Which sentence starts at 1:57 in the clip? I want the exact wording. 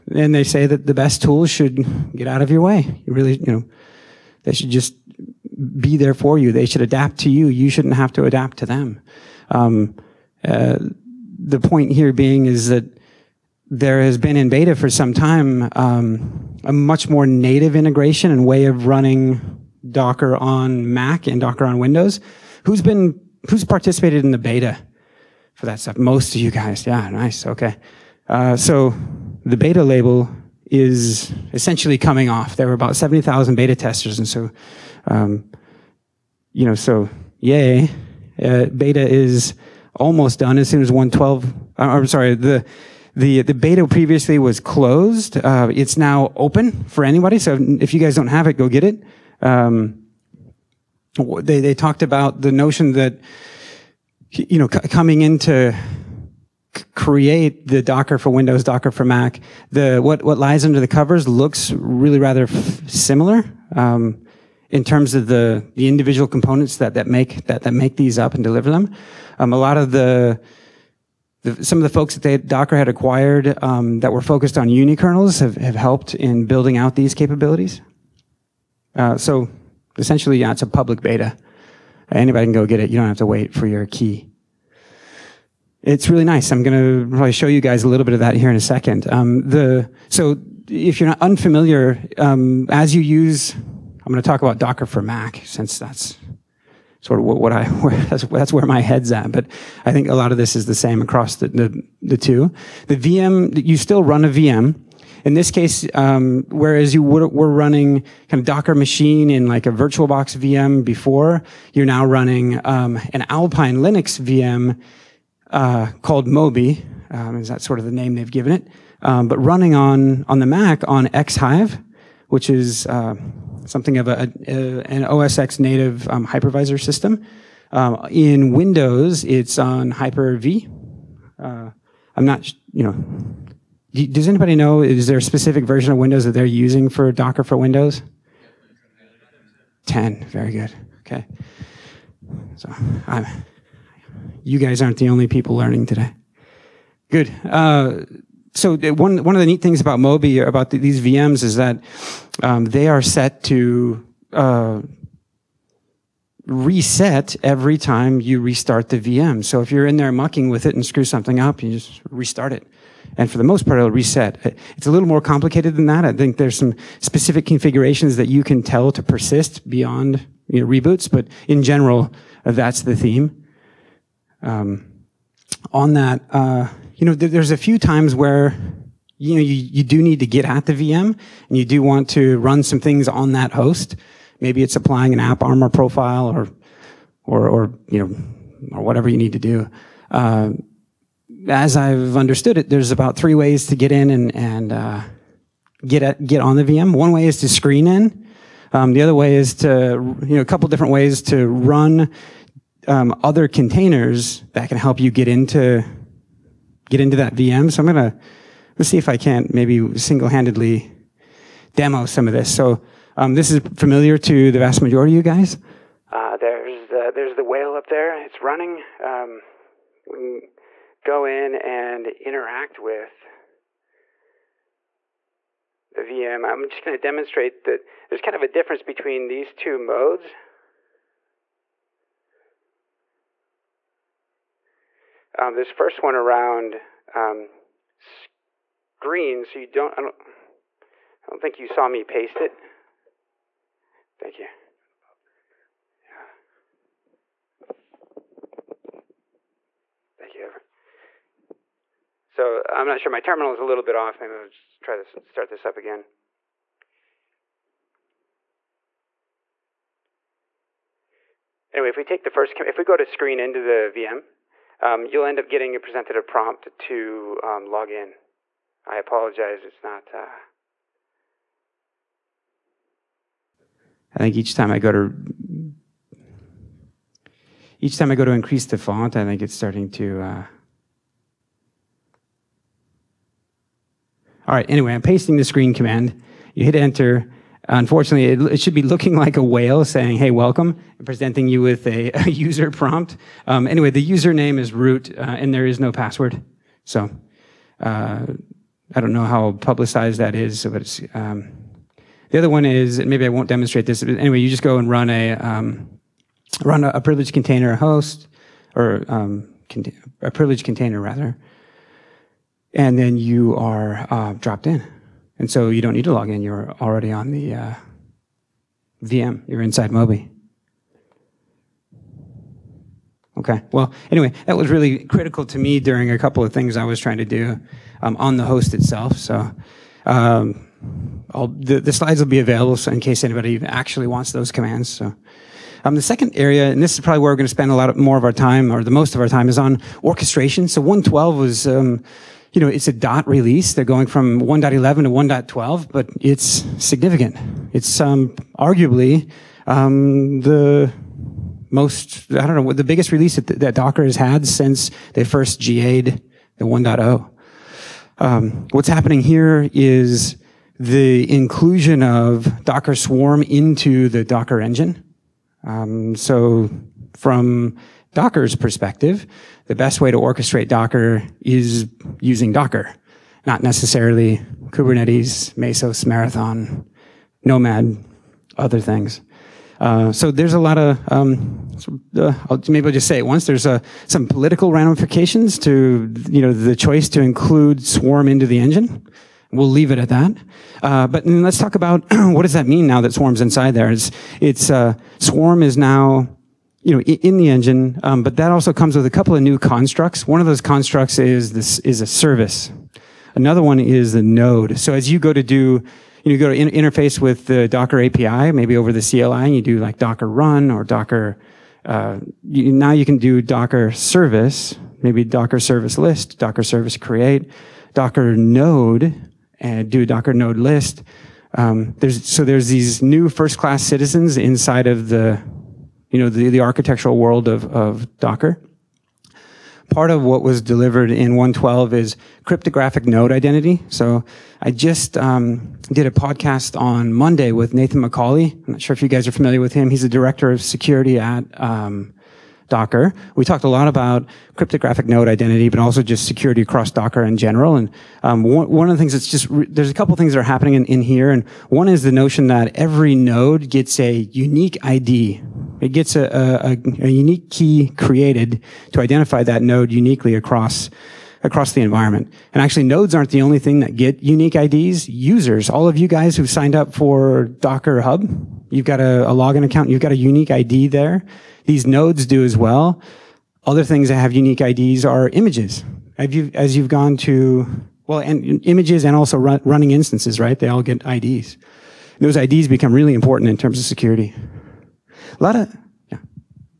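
Um, is that sort of the name they've given it?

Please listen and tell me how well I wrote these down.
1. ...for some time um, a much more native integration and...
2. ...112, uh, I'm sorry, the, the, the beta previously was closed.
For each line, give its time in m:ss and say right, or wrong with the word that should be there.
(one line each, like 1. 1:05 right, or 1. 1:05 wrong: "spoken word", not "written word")
1. 0:14 right
2. 0:40 right.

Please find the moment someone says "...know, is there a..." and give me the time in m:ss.
2:14.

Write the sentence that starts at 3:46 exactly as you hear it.
I'm just going to demonstrate that there's kind of a difference between these two modes.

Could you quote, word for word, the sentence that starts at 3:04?
Maybe it's applying an AppArmor profile or or or you know or whatever you need to do.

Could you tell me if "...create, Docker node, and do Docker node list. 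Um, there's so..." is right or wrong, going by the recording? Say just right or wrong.
right.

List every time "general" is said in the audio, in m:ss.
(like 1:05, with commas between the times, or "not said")
2:51, 7:27.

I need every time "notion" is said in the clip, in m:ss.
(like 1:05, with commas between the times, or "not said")
0:52, 7:32.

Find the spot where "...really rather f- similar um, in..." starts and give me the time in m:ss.
1:01.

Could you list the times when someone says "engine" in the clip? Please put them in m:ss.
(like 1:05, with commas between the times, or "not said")
6:04, 6:28, 6:37.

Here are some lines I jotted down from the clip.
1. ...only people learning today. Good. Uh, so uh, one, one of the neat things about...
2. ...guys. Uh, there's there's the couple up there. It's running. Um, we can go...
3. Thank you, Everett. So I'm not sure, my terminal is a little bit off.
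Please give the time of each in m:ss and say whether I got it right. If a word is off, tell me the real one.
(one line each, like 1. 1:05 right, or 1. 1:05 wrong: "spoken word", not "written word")
1. 2:25 right
2. 3:35 wrong: "whale", not "couple"
3. 4:10 right.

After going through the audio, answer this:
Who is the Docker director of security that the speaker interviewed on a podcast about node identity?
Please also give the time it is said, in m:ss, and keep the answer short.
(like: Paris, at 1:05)
Nathan McCauley, at 7:17.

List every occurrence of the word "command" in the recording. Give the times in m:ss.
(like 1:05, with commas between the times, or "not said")
4:45, 5:34.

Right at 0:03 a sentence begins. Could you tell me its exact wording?
You really, you know, they should just be there for you.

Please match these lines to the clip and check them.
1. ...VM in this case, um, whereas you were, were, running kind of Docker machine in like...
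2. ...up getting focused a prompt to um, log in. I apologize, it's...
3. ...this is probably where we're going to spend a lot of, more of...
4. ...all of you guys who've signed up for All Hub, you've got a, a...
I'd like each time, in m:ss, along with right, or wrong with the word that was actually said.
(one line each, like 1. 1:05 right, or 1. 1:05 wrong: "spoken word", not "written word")
1. 1:44 right
2. 4:25 wrong: "presented", not "focused"
3. 5:36 right
4. 7:45 wrong: "Docker", not "All".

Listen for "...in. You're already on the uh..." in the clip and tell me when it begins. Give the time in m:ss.
5:16.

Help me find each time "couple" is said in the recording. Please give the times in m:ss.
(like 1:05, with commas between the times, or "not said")
3:20, 5:26, 6:39, 7:29.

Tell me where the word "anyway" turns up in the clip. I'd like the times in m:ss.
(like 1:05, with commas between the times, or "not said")
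4:21, 4:44, 4:53, 5:04, 5:24.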